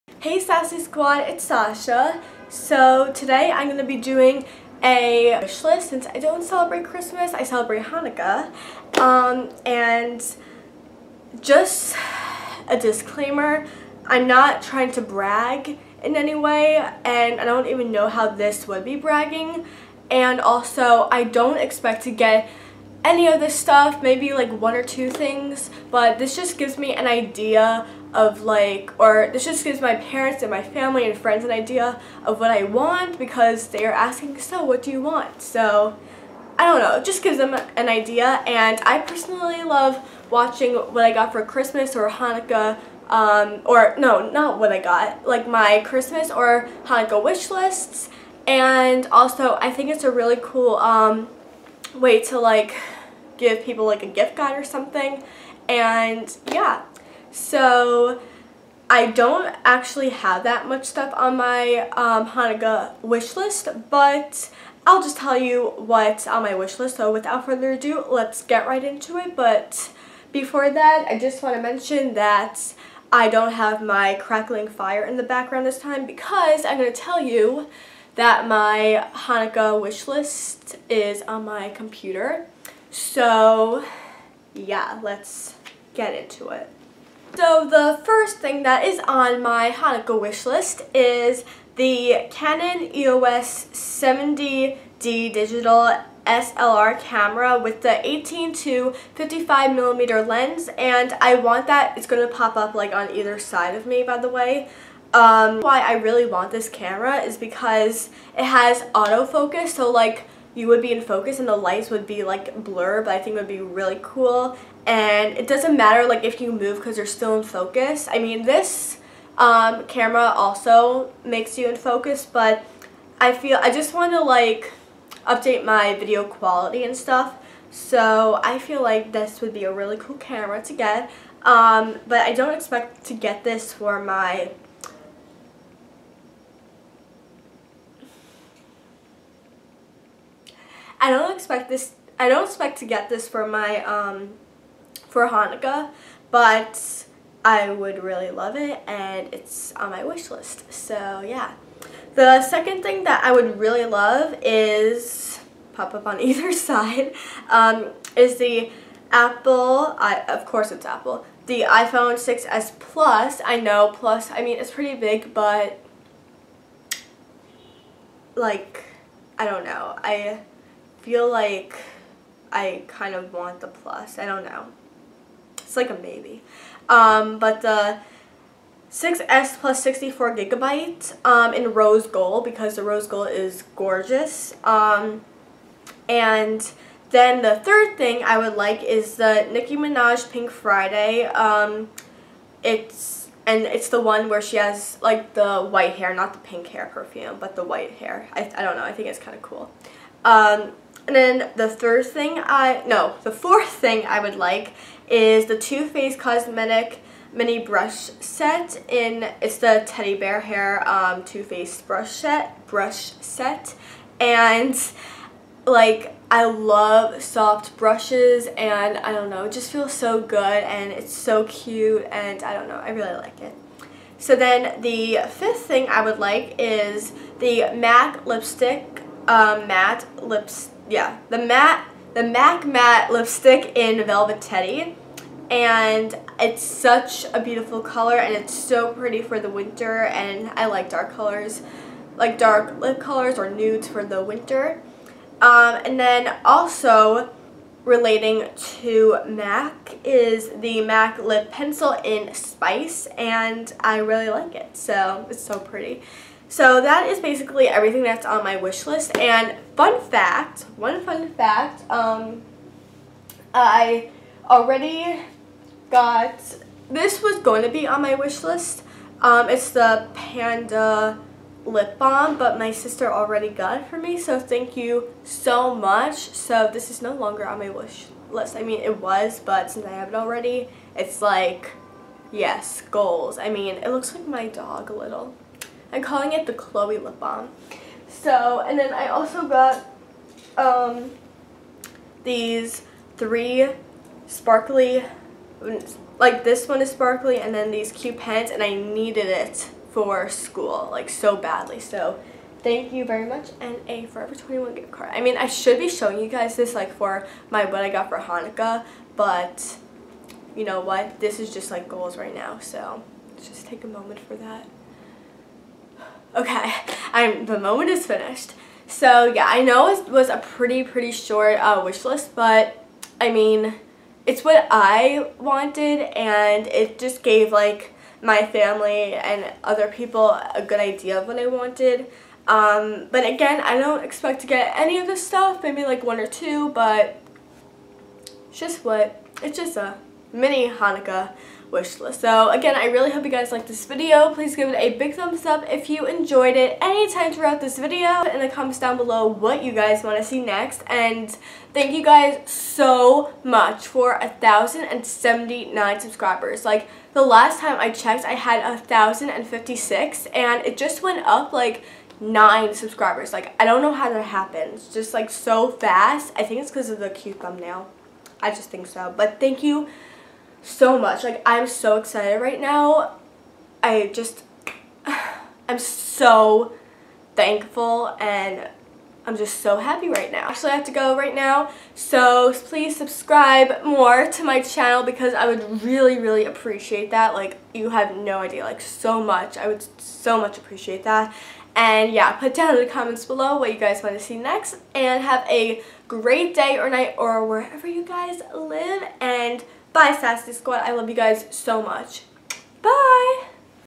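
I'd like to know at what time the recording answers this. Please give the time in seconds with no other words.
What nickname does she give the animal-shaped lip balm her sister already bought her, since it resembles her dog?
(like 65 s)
286 s.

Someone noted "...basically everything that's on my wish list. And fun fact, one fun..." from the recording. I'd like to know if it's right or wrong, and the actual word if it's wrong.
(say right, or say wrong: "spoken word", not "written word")
right.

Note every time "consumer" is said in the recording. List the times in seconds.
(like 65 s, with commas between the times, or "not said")
not said.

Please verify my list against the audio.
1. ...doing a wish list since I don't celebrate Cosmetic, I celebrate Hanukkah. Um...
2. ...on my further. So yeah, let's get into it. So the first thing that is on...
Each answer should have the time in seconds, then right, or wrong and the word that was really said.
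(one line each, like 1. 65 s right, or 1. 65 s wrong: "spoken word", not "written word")
1. 3 s wrong: "Christmas", not "Cosmetic"
2. 81 s wrong: "computer", not "further".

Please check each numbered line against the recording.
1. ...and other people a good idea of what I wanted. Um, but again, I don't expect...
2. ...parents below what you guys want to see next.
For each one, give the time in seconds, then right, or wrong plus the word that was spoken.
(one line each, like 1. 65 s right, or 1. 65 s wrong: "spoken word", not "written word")
1. 329 s right
2. 392 s wrong: "comments", not "parents".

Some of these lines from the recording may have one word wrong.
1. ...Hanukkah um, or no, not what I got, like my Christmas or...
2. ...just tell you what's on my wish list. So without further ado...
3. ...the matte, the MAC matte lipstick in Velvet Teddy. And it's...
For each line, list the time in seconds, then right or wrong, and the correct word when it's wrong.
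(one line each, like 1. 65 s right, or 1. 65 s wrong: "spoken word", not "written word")
1. 42 s right
2. 65 s right
3. 231 s right.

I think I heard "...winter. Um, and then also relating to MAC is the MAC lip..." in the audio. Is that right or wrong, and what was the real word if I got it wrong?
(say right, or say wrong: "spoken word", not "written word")
right.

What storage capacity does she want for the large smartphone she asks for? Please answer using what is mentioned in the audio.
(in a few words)
64 gigabytes.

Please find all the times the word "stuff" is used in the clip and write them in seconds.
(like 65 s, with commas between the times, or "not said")
23 s, 60 s, 126 s, 335 s.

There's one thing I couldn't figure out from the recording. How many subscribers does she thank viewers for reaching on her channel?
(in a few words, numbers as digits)
1,079.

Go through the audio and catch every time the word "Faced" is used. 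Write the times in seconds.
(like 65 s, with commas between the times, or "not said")
205 s, 211 s.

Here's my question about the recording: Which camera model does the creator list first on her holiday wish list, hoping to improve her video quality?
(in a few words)
Canon EOS 70D.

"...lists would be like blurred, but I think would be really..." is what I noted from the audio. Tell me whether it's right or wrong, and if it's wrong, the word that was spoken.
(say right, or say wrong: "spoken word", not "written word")
wrong: "lights", not "lists".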